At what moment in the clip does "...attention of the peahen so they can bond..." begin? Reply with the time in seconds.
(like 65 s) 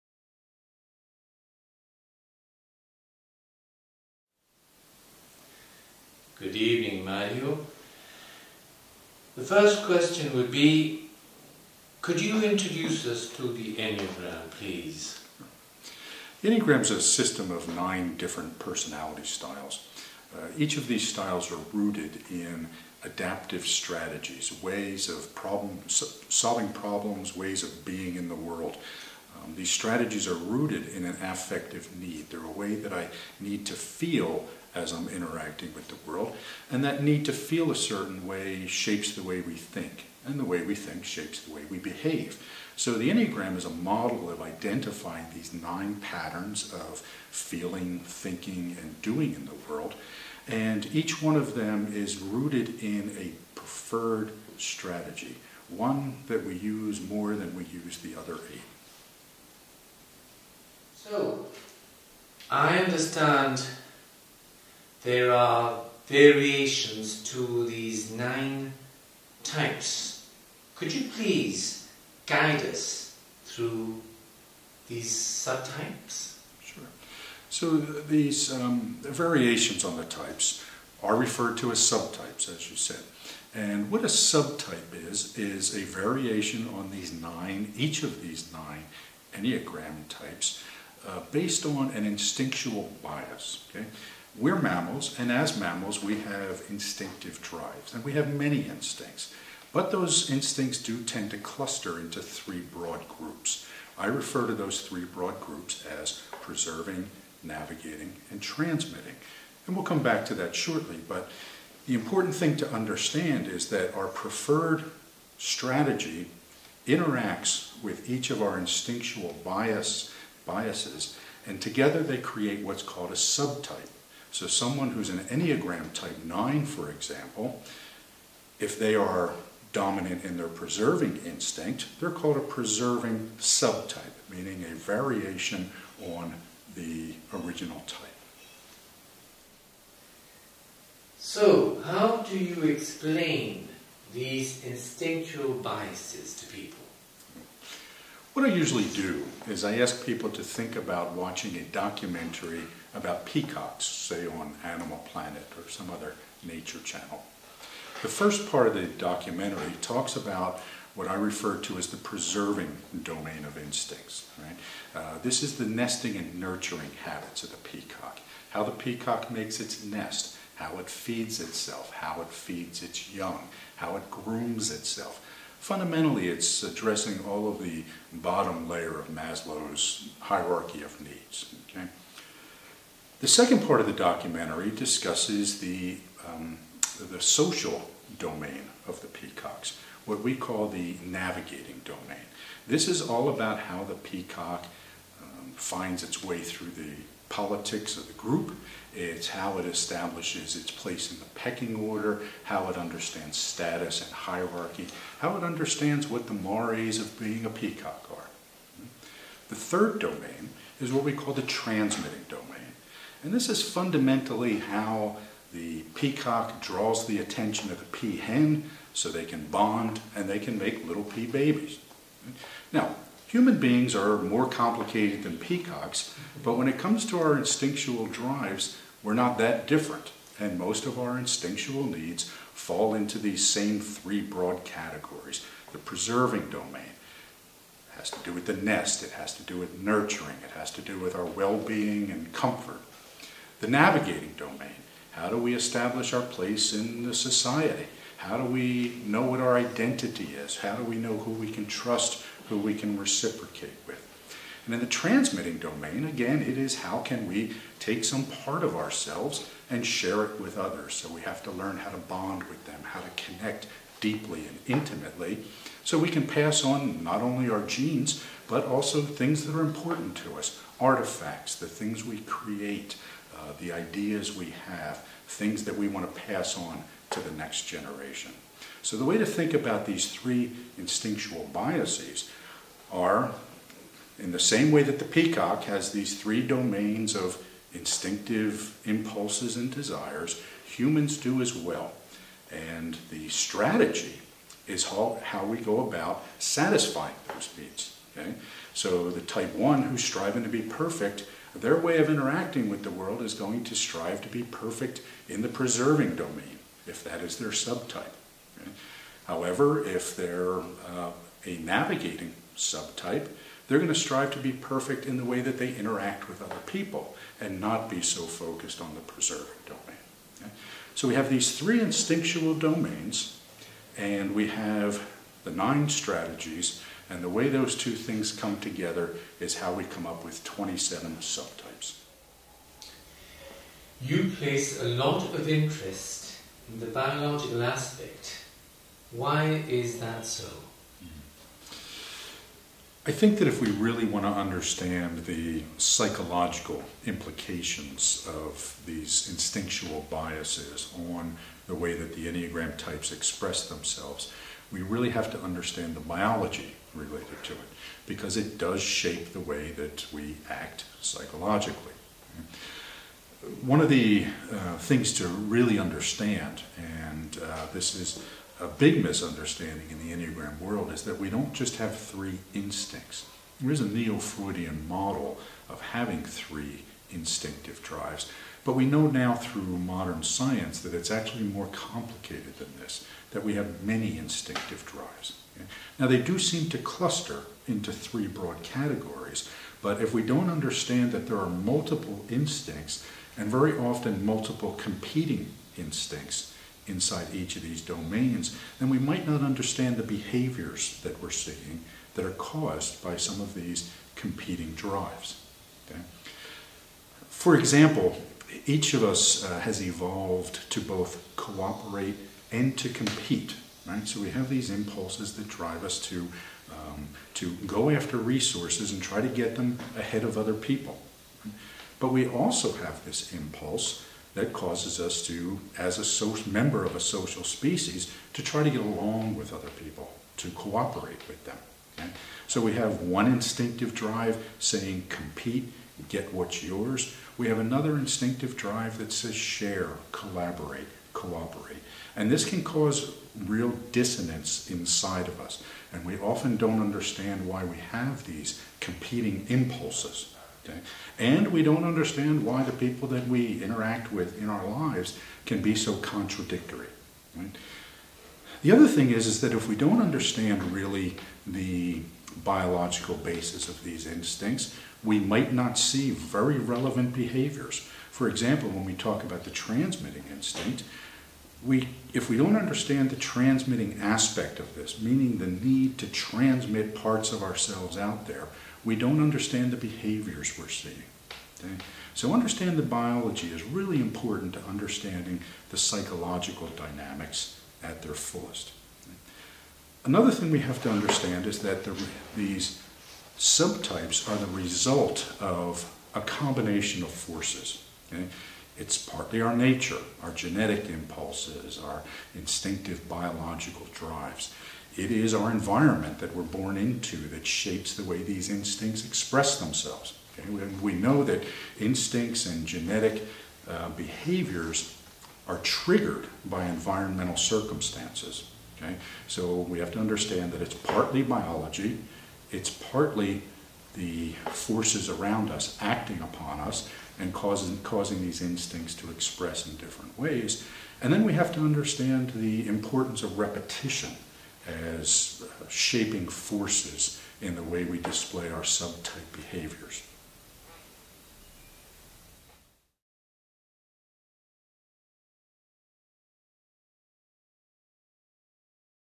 217 s.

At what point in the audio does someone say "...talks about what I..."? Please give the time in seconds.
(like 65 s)
159 s.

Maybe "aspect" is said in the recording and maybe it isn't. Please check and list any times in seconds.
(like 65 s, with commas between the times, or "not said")
337 s, 474 s.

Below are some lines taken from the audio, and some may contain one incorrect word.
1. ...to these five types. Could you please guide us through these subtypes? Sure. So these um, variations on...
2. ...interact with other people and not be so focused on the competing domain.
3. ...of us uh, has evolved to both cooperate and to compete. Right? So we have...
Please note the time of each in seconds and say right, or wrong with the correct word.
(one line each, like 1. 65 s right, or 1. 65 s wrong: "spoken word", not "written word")
1. 67 s wrong: "nine", not "five"
2. 315 s wrong: "preserving", not "competing"
3. 408 s right.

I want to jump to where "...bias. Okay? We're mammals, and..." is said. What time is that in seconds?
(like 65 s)
93 s.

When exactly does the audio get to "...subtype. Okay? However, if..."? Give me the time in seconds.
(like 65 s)
307 s.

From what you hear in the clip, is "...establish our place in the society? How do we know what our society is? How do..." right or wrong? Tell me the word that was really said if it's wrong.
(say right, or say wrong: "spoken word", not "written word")
wrong: "identity", not "society".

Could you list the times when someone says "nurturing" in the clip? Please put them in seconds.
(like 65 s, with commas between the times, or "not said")
166 s, 239 s.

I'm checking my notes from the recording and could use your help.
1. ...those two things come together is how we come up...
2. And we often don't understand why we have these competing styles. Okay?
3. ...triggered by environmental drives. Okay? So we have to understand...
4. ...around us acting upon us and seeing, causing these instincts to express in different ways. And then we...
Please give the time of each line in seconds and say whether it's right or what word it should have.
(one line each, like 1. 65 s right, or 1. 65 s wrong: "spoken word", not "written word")
1. 327 s right
2. 445 s wrong: "impulses", not "styles"
3. 515 s wrong: "circumstances", not "drives"
4. 525 s wrong: "causing", not "seeing".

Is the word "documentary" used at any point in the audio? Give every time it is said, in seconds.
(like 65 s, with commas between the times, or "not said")
151 s, 158 s, 183 s.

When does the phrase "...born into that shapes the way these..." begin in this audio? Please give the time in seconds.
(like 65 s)
506 s.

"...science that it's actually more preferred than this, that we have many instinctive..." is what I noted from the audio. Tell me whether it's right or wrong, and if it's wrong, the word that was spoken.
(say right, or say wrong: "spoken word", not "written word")
wrong: "complicated", not "preferred".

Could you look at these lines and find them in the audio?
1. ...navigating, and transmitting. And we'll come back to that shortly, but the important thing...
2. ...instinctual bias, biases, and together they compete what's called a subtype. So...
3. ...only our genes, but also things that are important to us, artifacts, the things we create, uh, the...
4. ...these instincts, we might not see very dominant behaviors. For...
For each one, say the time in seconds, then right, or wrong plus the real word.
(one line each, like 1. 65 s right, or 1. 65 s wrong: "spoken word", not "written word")
1. 107 s right
2. 118 s wrong: "create", not "compete"
3. 267 s right
4. 463 s wrong: "relevant", not "dominant".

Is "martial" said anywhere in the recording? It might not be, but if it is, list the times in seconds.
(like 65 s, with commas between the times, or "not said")
not said.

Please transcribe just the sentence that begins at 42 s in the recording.
So the Enneagram is a model of identifying these nine patterns of feeling, thinking, and doing in the world.